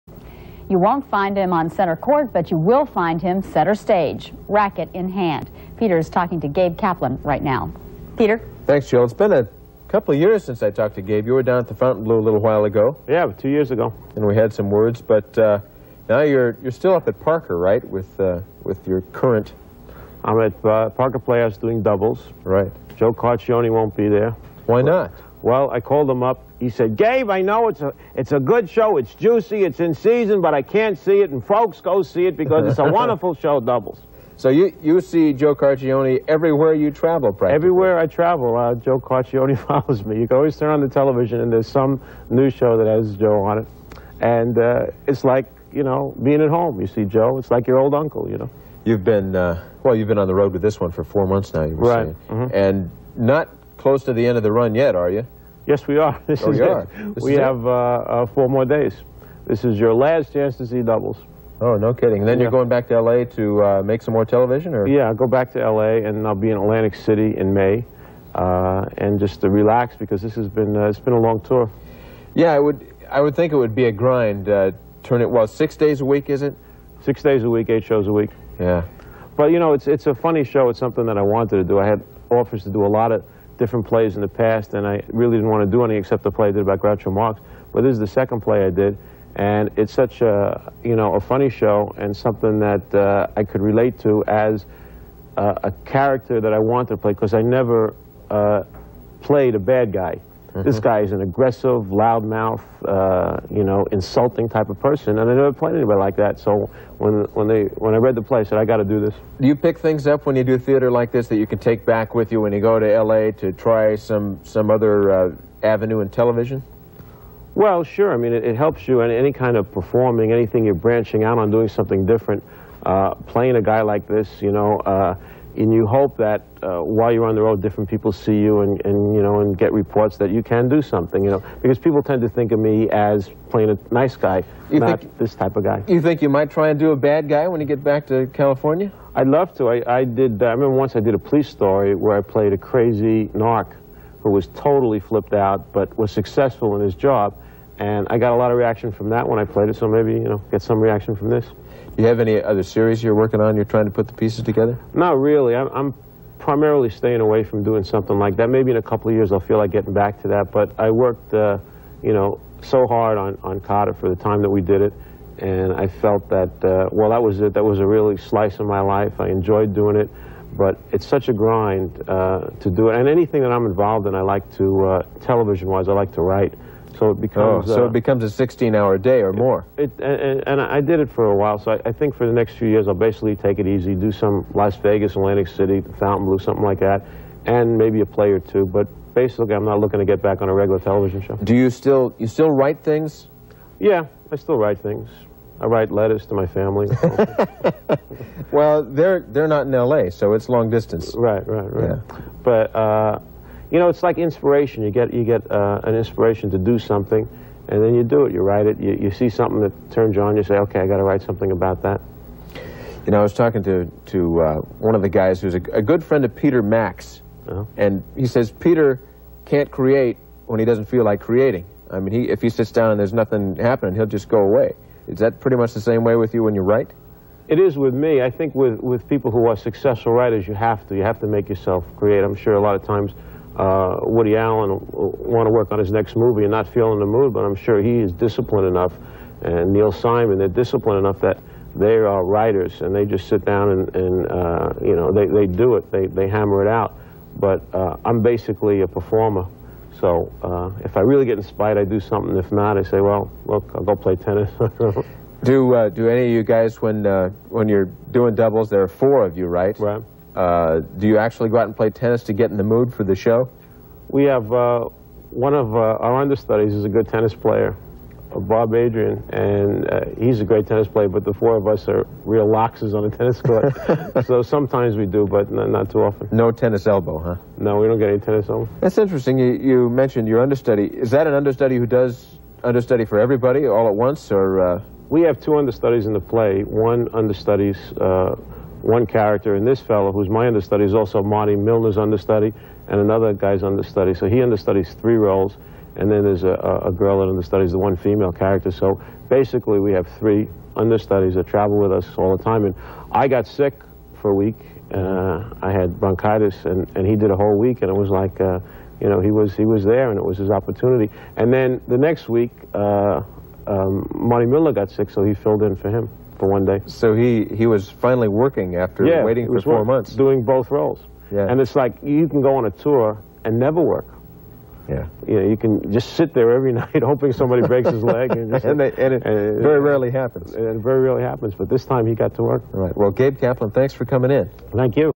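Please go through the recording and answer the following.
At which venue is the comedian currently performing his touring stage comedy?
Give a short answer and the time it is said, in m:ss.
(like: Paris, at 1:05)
Parker Playhouse, at 0:20.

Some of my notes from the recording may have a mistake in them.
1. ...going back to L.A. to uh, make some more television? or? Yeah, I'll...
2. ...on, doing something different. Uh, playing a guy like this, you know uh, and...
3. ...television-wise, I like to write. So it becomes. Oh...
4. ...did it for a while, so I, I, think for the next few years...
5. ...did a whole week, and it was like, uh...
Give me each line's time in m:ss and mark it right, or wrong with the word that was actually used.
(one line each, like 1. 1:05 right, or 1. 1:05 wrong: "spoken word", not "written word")
1. 1:02 right
2. 2:01 right
3. 2:55 right
4. 3:00 right
5. 5:07 right.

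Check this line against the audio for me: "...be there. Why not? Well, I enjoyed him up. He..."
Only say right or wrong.
wrong.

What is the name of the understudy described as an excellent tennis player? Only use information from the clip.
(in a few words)
Bob Adrian.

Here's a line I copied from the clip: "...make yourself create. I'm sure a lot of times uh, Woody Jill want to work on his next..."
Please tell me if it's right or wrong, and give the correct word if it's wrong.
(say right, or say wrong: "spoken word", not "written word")
wrong: "Allen", not "Jill".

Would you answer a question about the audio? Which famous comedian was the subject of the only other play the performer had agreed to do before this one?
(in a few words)
Groucho Marx.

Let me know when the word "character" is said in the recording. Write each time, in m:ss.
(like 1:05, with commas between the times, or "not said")
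1:35, 4:49, 4:58.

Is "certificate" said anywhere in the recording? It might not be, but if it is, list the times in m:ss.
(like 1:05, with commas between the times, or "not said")
not said.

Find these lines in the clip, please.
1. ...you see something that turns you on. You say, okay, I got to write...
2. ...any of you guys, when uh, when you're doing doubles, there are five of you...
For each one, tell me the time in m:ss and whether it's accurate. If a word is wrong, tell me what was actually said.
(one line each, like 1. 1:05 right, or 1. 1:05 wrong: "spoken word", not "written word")
1. 3:28 right
2. 4:16 wrong: "four", not "five".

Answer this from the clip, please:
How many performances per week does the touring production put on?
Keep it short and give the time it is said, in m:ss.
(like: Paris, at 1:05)
8, at 1:17.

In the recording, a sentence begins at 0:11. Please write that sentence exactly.
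You were down at the Fontainebleau a little while ago.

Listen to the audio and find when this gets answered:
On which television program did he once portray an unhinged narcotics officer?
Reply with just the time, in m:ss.
2:21.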